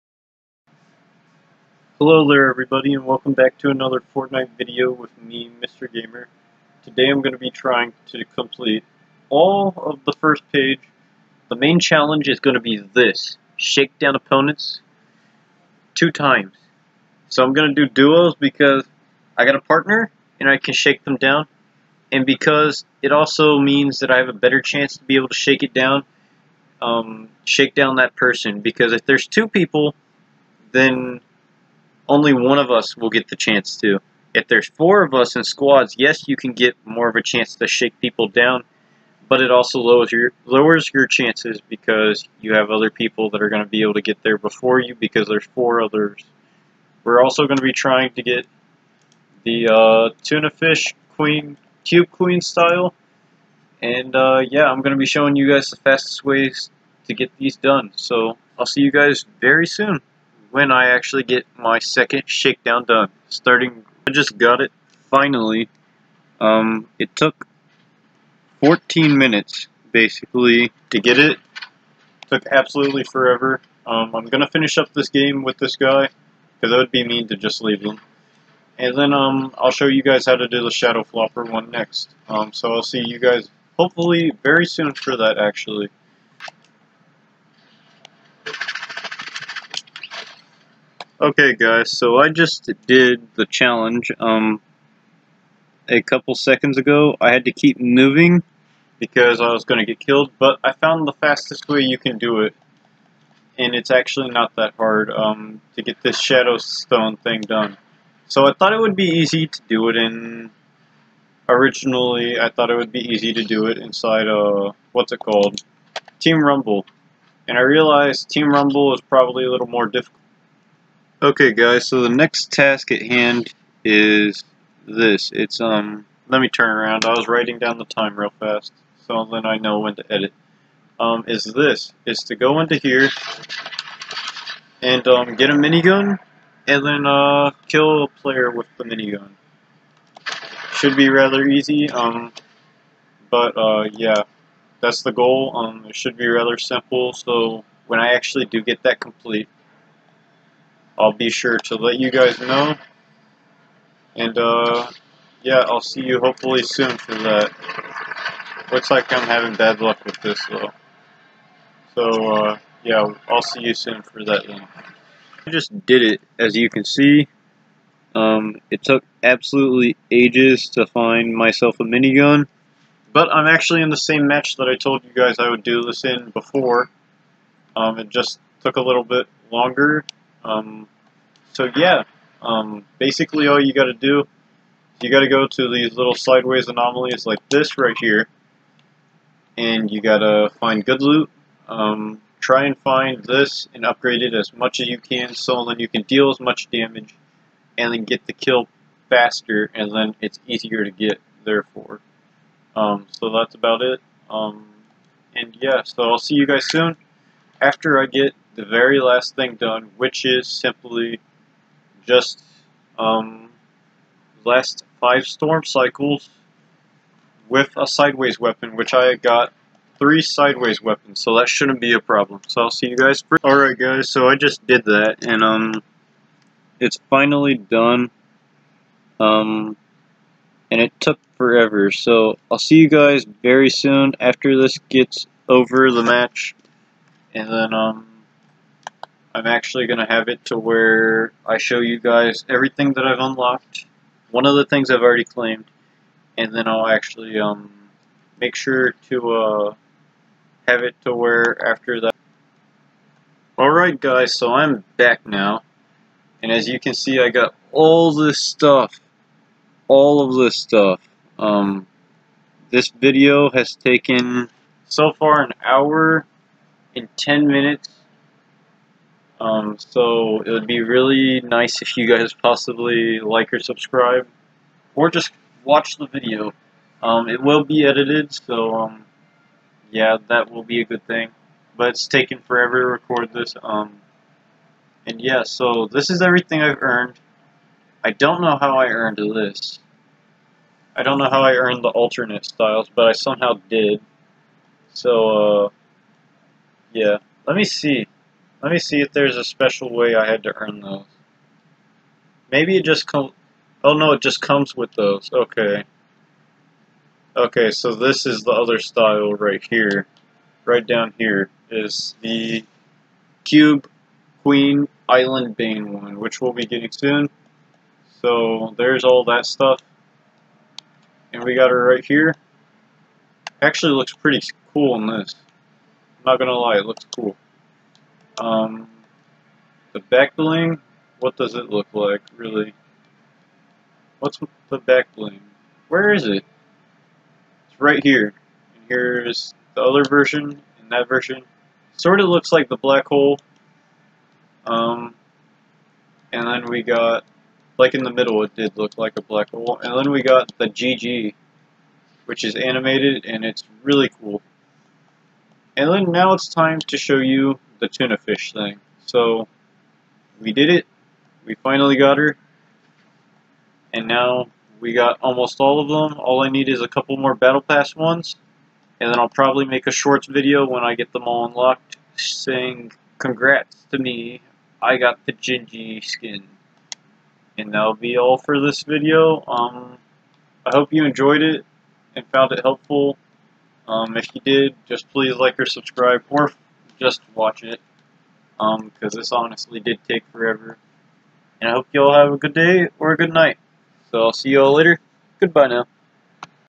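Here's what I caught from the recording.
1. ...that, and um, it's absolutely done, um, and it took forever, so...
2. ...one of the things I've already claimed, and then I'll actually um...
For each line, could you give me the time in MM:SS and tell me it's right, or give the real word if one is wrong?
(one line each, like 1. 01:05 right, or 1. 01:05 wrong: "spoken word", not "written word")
1. 03:44 wrong: "finally", not "absolutely"
2. 04:04 right.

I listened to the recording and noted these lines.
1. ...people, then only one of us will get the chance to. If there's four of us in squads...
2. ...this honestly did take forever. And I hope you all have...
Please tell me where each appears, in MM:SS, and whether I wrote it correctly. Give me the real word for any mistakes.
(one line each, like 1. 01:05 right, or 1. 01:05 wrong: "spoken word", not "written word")
1. 00:29 right
2. 06:29 right.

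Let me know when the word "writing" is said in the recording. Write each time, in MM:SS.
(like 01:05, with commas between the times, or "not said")
02:07.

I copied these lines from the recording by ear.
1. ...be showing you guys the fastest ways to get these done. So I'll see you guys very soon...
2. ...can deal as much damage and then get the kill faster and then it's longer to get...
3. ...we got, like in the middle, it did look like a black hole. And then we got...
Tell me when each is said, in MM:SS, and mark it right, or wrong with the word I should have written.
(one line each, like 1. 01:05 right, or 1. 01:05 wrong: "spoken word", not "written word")
1. 00:54 right
2. 03:15 wrong: "easier", not "longer"
3. 05:46 right.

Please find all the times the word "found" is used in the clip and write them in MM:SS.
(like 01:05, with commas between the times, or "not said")
01:40, 06:22.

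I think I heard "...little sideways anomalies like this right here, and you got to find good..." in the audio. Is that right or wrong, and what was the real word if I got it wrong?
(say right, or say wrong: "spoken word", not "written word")
right.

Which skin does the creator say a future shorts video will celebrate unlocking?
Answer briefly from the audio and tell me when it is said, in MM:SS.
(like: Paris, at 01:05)
Gingy, at 06:15.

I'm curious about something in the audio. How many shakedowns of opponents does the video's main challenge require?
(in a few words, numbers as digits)
2.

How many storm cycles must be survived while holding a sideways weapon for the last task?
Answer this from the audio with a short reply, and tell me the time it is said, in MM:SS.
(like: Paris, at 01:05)
5, at 03:34.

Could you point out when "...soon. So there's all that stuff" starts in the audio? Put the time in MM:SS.
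05:16.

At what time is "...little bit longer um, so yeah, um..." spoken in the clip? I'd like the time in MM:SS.
02:58.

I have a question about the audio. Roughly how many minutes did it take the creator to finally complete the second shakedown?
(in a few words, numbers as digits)
14.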